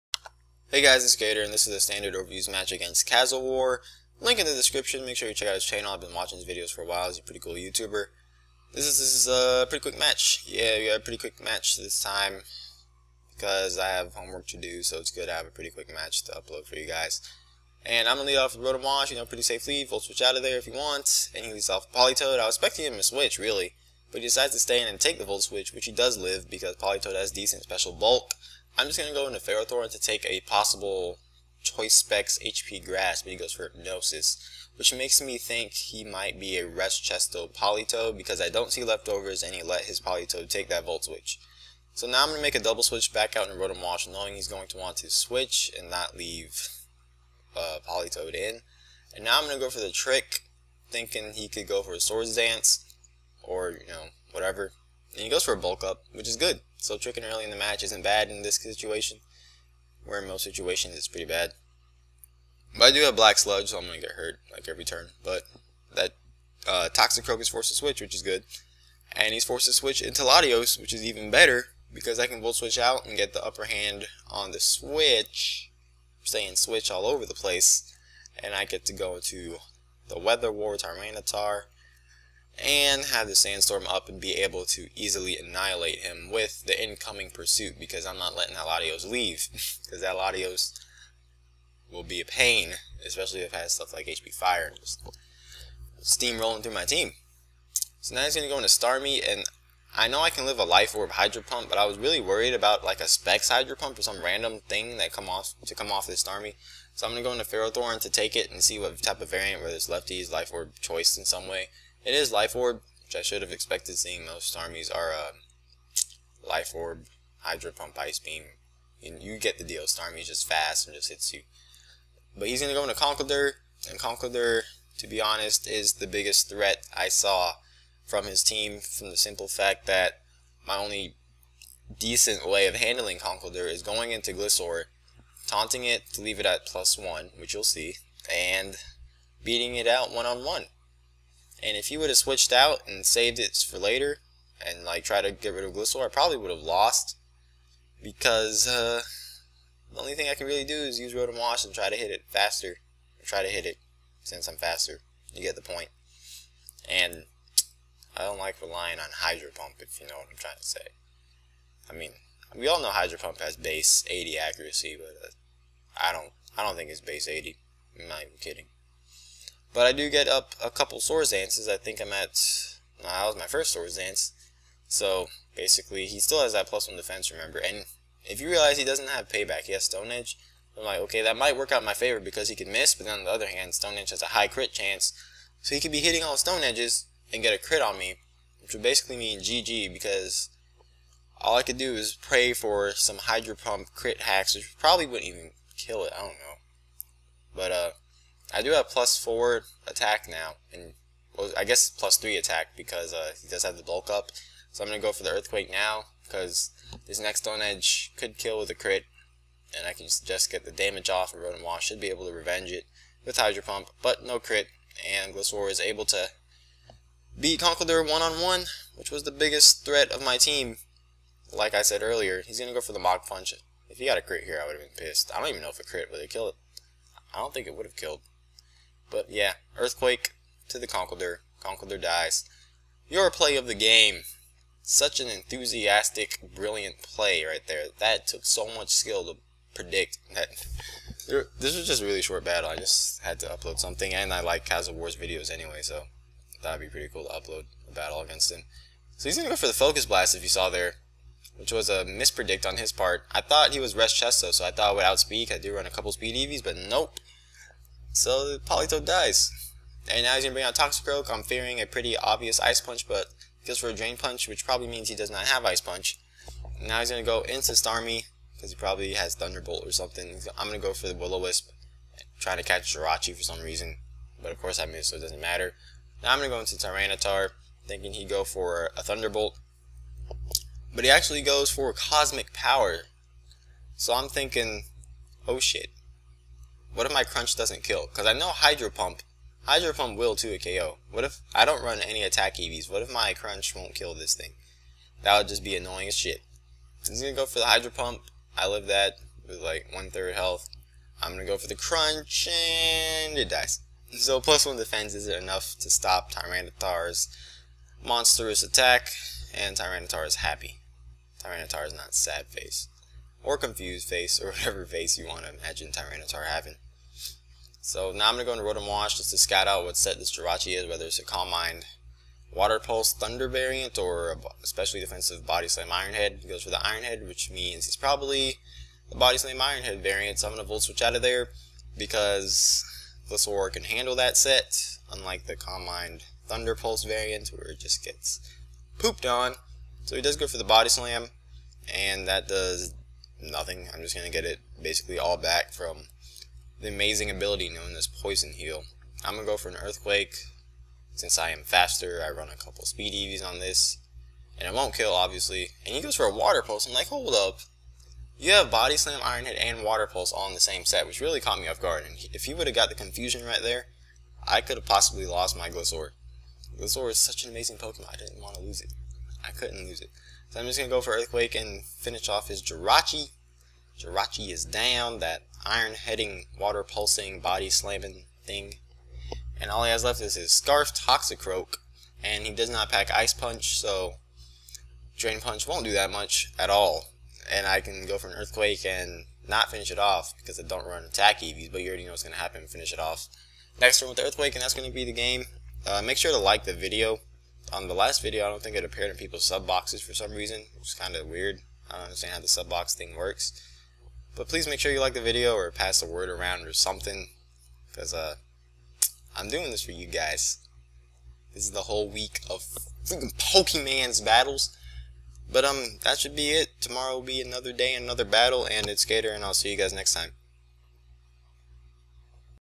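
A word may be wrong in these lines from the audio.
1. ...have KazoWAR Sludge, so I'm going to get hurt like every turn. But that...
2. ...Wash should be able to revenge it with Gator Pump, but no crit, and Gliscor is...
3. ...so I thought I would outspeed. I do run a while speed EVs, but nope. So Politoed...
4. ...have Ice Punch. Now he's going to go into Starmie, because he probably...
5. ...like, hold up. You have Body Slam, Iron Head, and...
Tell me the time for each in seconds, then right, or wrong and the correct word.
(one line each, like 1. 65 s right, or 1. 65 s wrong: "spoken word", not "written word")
1. 63 s wrong: "Black", not "KazoWAR"
2. 211 s wrong: "Hydro", not "Gator"
3. 254 s wrong: "couple", not "while"
4. 265 s right
5. 356 s right.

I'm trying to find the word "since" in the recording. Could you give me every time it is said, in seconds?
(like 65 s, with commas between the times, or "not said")
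154 s, 351 s.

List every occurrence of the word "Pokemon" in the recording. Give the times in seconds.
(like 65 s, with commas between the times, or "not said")
367 s, 413 s.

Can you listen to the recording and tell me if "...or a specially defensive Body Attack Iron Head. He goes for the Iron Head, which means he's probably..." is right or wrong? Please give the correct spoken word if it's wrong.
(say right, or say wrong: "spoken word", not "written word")
wrong: "Slam", not "Attack".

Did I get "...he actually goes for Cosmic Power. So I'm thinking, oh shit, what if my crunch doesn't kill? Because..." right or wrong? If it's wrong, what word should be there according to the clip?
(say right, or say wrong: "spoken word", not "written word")
right.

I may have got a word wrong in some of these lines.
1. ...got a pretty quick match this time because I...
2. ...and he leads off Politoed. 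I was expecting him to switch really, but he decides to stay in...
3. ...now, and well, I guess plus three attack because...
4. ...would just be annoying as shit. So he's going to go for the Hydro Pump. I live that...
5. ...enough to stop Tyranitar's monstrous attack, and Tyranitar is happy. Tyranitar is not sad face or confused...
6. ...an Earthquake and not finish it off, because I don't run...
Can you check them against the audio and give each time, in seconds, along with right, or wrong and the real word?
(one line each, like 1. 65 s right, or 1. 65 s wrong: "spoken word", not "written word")
1. 10 s right
2. 21 s right
3. 200 s right
4. 295 s right
5. 305 s right
6. 388 s right.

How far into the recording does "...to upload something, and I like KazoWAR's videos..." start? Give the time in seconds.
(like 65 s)
243 s.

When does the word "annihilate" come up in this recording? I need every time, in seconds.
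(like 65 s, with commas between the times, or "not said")
85 s.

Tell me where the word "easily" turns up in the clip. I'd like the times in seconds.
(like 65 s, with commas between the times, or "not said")
84 s.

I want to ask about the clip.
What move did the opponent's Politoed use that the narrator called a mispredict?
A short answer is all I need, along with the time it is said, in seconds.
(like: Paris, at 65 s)
Focus Blast, at 249 s.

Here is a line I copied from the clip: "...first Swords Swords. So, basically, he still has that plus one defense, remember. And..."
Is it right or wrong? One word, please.
wrong.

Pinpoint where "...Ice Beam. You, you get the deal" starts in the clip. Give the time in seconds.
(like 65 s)
117 s.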